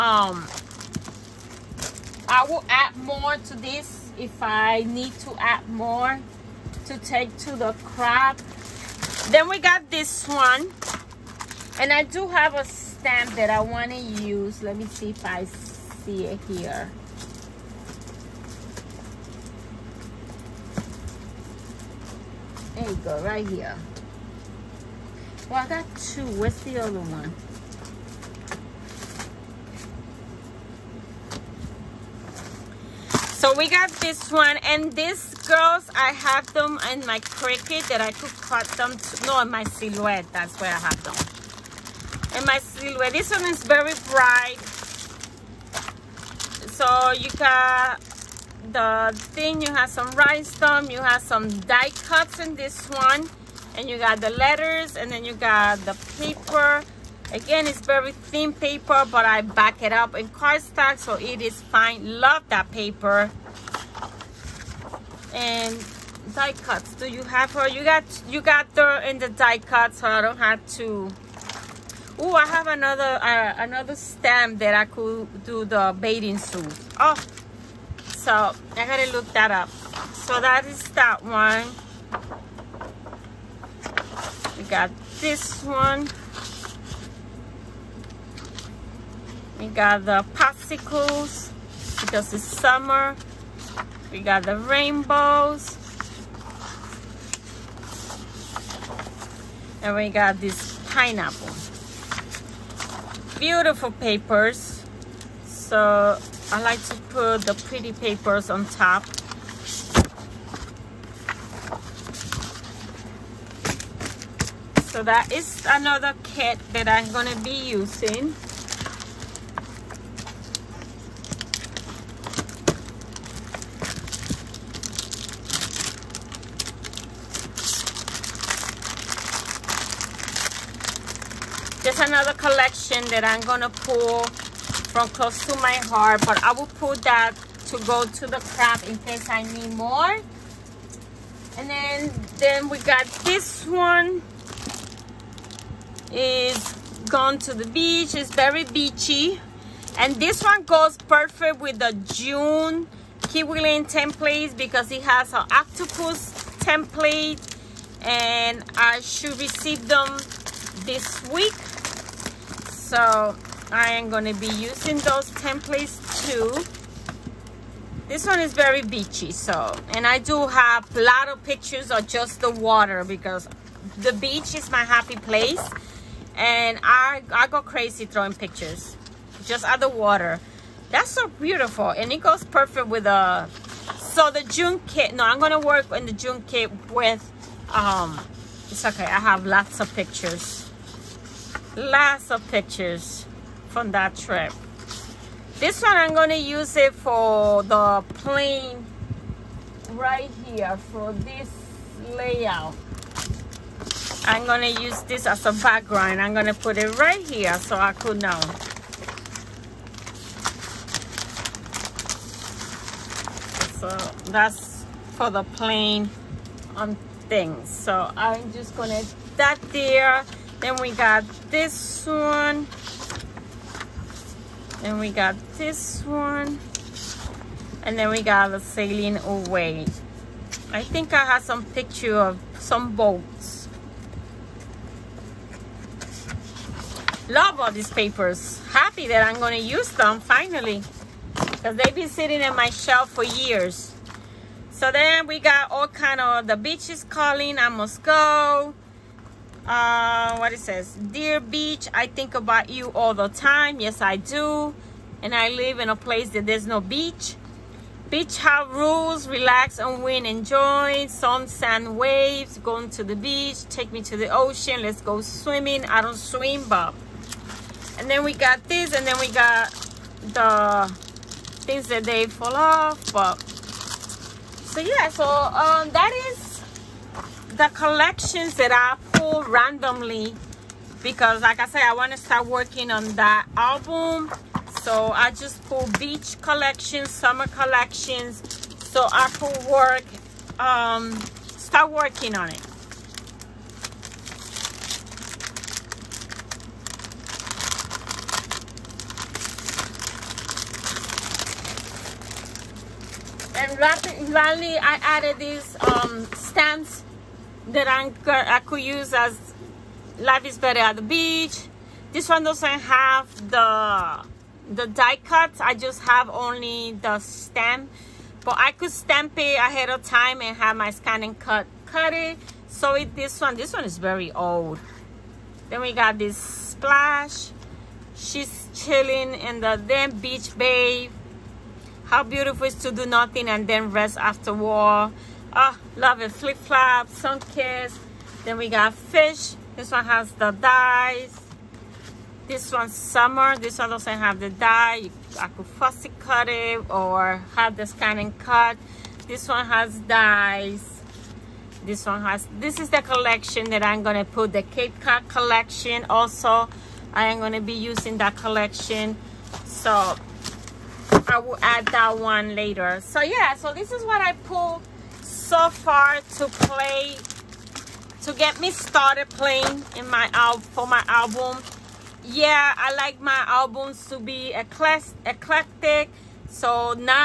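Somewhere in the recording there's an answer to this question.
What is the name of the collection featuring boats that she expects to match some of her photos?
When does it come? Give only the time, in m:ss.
3:48.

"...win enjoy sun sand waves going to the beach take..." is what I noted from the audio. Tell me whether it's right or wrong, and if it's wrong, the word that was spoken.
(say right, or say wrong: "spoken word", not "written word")
right.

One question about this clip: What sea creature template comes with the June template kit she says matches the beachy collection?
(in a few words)
Octopus.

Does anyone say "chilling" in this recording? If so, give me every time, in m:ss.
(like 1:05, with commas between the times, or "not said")
5:28.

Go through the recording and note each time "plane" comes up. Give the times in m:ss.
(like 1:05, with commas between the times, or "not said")
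3:18, 3:35.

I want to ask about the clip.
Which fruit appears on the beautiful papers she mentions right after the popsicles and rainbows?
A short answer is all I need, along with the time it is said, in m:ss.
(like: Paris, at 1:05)
Pineapple, at 1:40.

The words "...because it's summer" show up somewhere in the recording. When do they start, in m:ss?
1:32.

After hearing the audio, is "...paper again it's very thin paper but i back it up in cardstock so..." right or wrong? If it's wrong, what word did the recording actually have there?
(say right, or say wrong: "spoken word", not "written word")
right.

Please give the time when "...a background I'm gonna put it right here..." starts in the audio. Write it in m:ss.
3:25.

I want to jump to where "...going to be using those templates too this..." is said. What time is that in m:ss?
2:44.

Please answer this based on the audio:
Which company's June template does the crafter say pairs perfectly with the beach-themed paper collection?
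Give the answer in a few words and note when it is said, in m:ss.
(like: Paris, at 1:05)
Kiwi Lane, at 2:33.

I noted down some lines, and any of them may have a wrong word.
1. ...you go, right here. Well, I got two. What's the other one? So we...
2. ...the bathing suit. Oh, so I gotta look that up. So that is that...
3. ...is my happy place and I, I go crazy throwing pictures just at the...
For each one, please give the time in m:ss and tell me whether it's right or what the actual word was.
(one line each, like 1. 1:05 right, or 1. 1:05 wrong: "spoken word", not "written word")
1. 0:22 right
2. 1:15 right
3. 2:54 right.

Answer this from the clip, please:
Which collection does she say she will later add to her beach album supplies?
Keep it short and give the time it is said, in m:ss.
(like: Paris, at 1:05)
Cape Cod, at 5:54.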